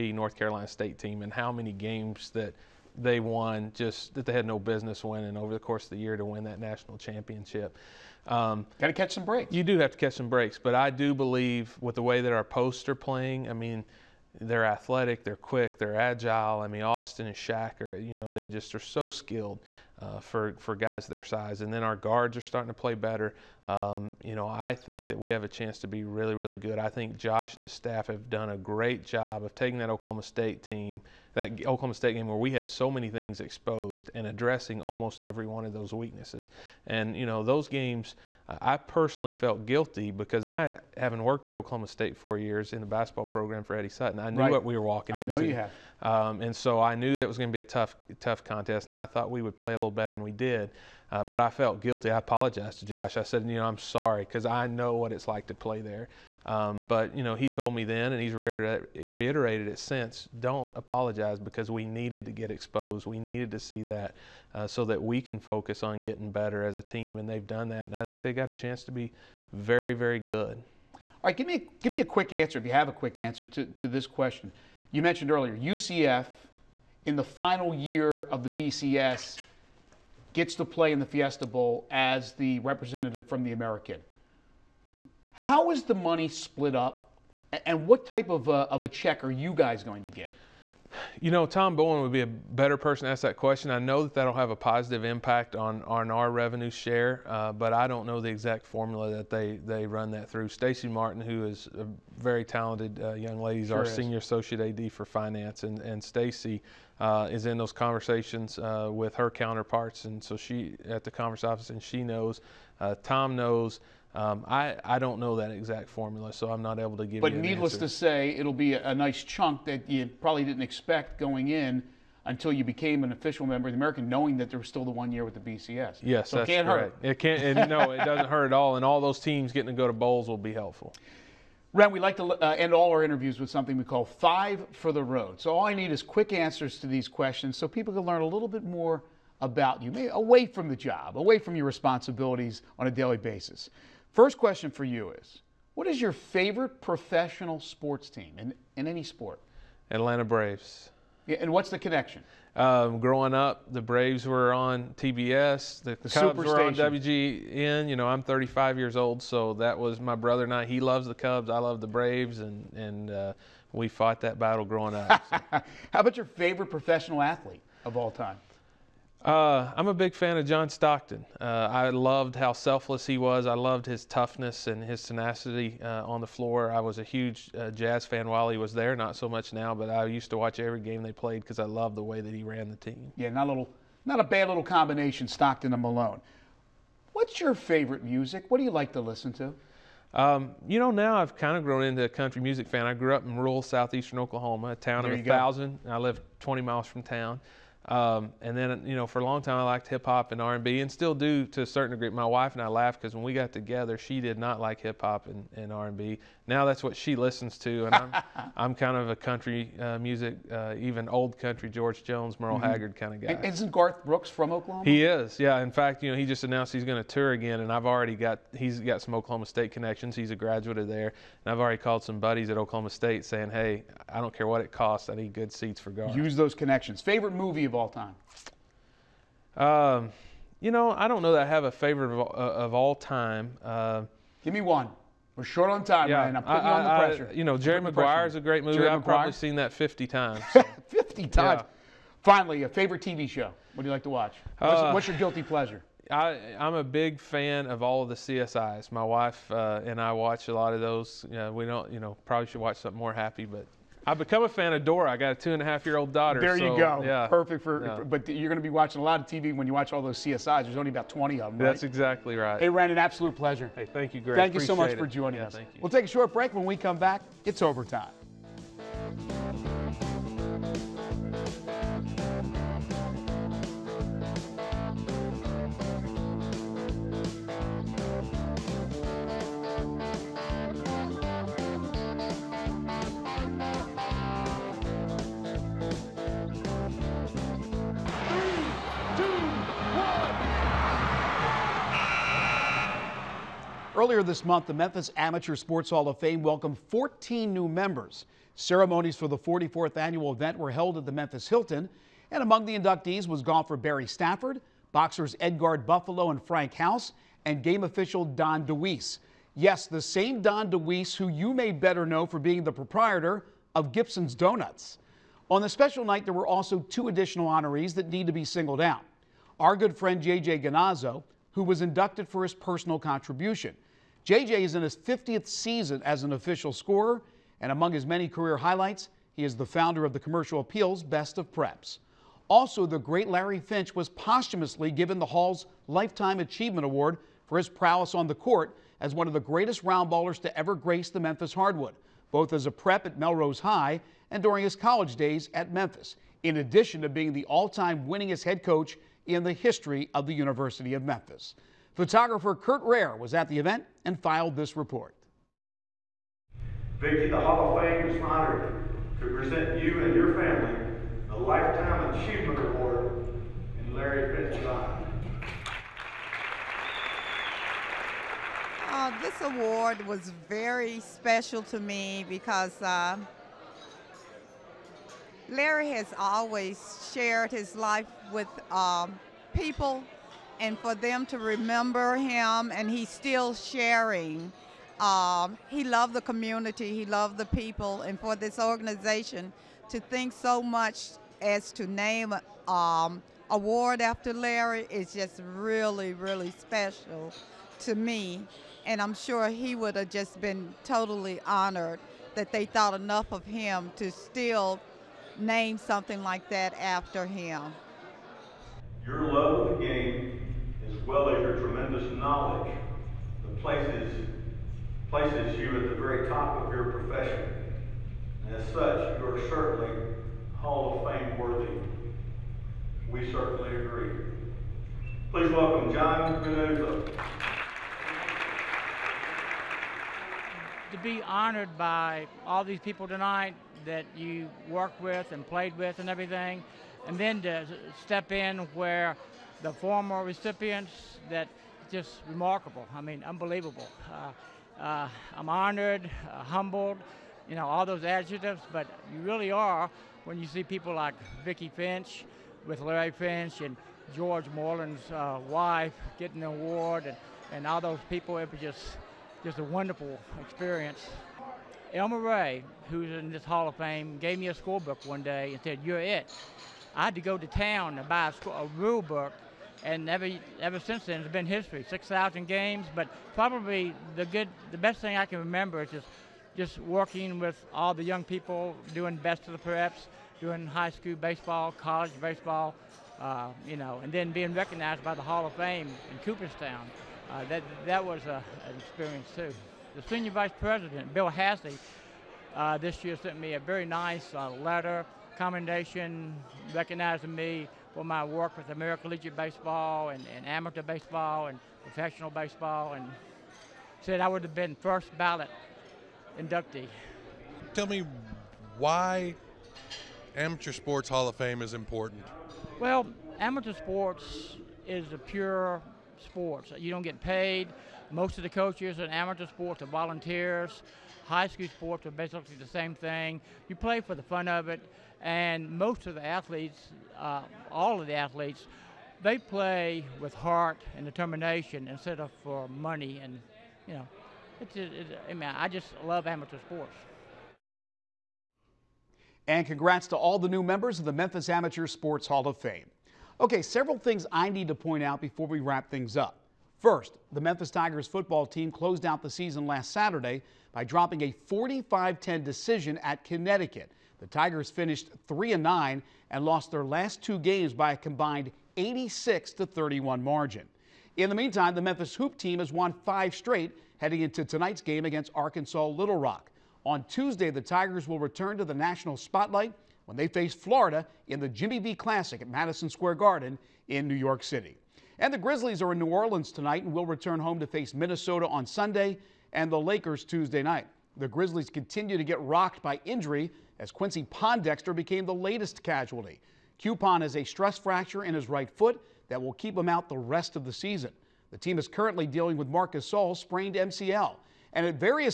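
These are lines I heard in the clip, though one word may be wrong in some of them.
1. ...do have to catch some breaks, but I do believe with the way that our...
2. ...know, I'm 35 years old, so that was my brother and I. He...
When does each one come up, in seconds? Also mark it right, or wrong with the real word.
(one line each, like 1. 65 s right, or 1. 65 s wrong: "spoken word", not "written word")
1. 9 s right
2. 157 s right.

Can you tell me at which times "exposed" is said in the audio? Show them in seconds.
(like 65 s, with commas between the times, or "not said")
33 s, 62 s.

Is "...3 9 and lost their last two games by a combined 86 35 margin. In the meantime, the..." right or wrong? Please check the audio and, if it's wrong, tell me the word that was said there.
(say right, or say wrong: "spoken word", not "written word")
wrong: "31", not "35".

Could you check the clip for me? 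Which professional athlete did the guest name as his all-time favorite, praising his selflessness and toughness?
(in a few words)
John Stockton.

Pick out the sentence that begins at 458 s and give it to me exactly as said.
It was just, just a wonderful experience.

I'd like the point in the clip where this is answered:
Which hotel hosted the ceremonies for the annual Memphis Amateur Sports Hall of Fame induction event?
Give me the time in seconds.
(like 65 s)
301 s.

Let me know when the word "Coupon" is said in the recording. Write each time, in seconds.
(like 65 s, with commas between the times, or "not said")
586 s.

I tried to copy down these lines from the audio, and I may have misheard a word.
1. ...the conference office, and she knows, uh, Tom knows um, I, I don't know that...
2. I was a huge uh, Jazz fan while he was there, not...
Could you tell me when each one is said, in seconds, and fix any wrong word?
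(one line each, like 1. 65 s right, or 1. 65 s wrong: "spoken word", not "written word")
1. 111 s right
2. 176 s right.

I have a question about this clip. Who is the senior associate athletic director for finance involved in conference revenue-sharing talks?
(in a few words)
Stacy Martin.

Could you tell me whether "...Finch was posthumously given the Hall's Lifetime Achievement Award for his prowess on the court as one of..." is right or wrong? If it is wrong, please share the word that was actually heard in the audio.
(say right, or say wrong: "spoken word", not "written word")
right.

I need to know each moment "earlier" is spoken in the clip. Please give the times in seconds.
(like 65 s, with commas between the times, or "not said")
75 s, 293 s.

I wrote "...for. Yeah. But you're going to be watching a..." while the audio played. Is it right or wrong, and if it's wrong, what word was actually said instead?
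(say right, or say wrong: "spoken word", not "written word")
right.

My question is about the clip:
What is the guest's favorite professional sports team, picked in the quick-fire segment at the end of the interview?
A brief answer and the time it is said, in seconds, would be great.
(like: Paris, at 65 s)
Atlanta Braves, at 149 s.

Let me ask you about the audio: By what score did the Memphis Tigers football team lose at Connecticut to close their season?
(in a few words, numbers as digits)
45-10.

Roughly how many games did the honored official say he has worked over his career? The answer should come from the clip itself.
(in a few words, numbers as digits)
6000.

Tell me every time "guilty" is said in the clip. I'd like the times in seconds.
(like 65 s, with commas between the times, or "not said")
39 s, 51 s, 245 s.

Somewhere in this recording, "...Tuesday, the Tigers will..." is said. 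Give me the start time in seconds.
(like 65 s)
567 s.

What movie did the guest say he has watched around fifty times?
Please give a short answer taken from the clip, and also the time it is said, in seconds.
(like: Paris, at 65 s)
Jerry Maguire, at 237 s.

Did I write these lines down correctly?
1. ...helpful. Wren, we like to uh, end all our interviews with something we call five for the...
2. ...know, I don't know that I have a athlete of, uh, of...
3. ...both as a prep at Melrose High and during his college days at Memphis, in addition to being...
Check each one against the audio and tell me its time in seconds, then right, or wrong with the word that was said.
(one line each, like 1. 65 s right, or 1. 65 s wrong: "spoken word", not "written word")
1. 130 s right
2. 230 s wrong: "favorite", not "athlete"
3. 342 s right.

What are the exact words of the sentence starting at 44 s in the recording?
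what we were walking I into.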